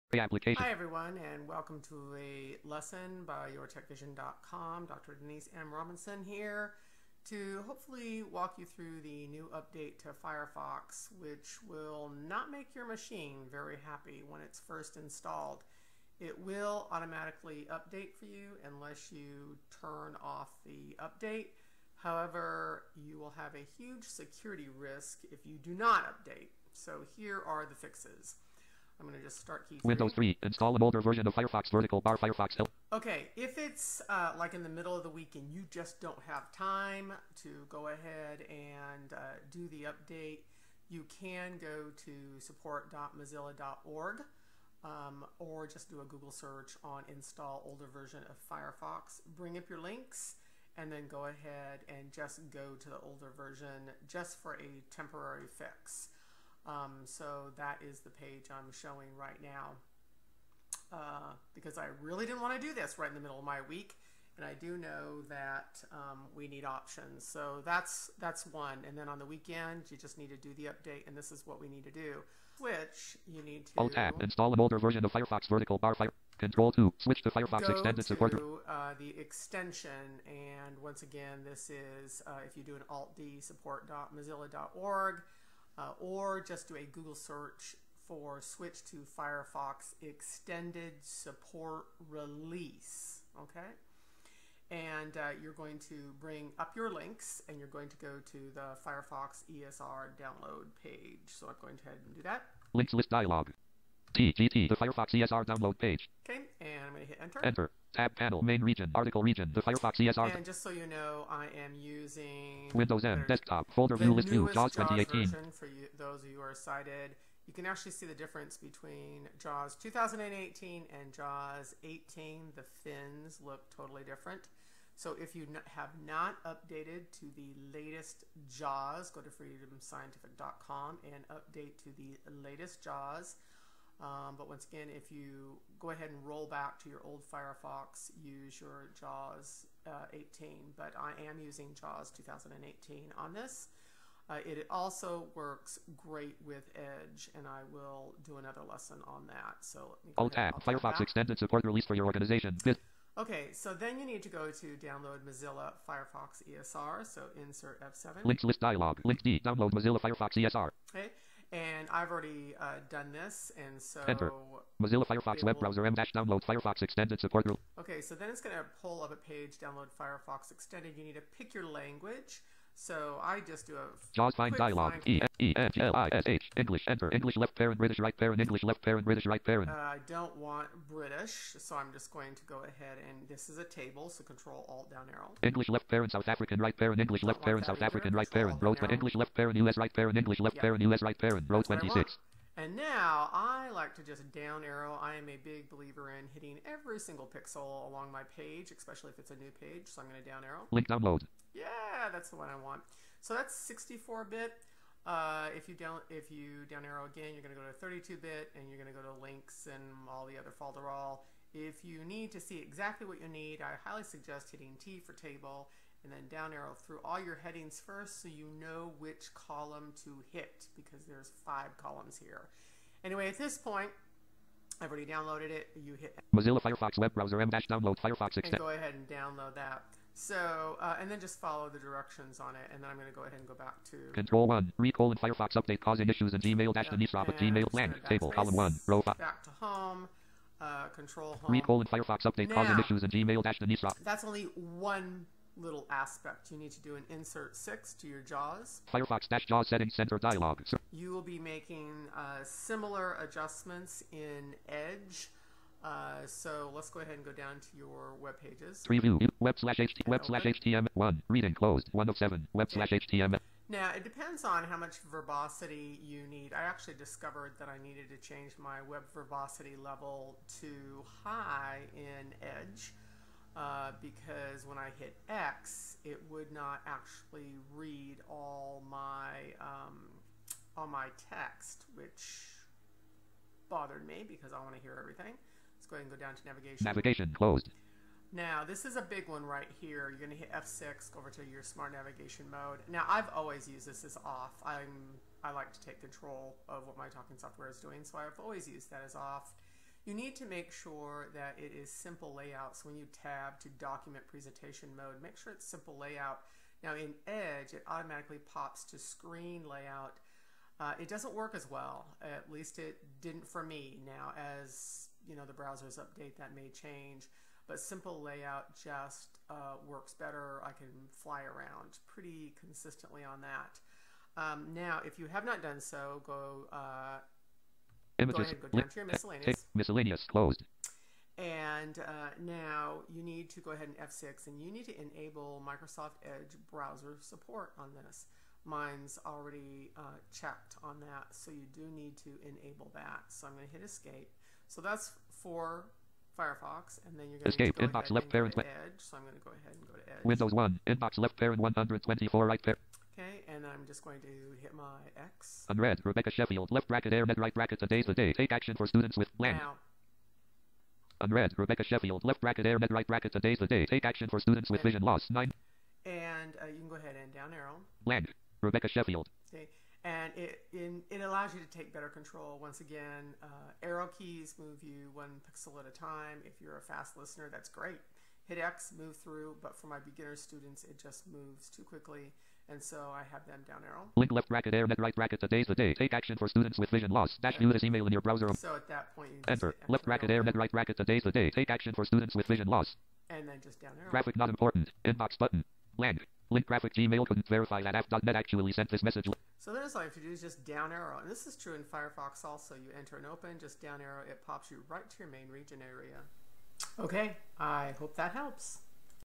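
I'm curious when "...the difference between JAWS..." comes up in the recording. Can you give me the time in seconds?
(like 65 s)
118 s.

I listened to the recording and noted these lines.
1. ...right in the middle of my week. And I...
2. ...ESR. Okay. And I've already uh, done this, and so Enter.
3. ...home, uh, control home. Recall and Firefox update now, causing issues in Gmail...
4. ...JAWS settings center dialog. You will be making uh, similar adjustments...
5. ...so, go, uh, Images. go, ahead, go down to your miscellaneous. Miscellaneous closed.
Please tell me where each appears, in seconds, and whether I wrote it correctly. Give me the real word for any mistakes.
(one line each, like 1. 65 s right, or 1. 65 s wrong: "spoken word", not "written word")
1. 62 s right
2. 160 s right
3. 239 s right
4. 249 s right
5. 325 s right.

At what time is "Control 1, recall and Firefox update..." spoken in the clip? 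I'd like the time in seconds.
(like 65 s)
234 s.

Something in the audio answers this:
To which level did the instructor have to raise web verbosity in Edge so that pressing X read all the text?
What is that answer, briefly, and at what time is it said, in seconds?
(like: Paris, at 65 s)
high, at 269 s.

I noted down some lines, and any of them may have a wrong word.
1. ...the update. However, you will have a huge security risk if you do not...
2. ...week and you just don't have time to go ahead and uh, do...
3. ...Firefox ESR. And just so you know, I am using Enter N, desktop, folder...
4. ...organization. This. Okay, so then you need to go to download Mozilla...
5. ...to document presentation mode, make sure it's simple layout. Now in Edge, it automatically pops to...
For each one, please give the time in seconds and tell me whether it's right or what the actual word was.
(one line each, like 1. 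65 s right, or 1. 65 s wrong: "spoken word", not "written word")
1. 20 s right
2. 35 s right
3. 109 s wrong: "Windows", not "Enter"
4. 152 s right
5. 303 s right.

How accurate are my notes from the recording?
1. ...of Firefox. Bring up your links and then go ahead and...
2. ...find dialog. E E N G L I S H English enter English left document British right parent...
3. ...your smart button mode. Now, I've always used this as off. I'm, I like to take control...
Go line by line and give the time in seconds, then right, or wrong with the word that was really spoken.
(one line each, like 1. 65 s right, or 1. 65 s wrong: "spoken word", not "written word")
1. 48 s right
2. 174 s wrong: "parent", not "document"
3. 291 s wrong: "navigation", not "button".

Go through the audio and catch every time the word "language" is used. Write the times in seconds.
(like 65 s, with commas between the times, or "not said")
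171 s.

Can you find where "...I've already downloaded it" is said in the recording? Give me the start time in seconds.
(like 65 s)
224 s.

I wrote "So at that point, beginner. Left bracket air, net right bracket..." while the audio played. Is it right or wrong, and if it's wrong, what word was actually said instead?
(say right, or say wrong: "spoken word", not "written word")
wrong: "enter", not "beginner".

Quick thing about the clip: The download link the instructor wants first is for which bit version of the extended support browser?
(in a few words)
64-bit.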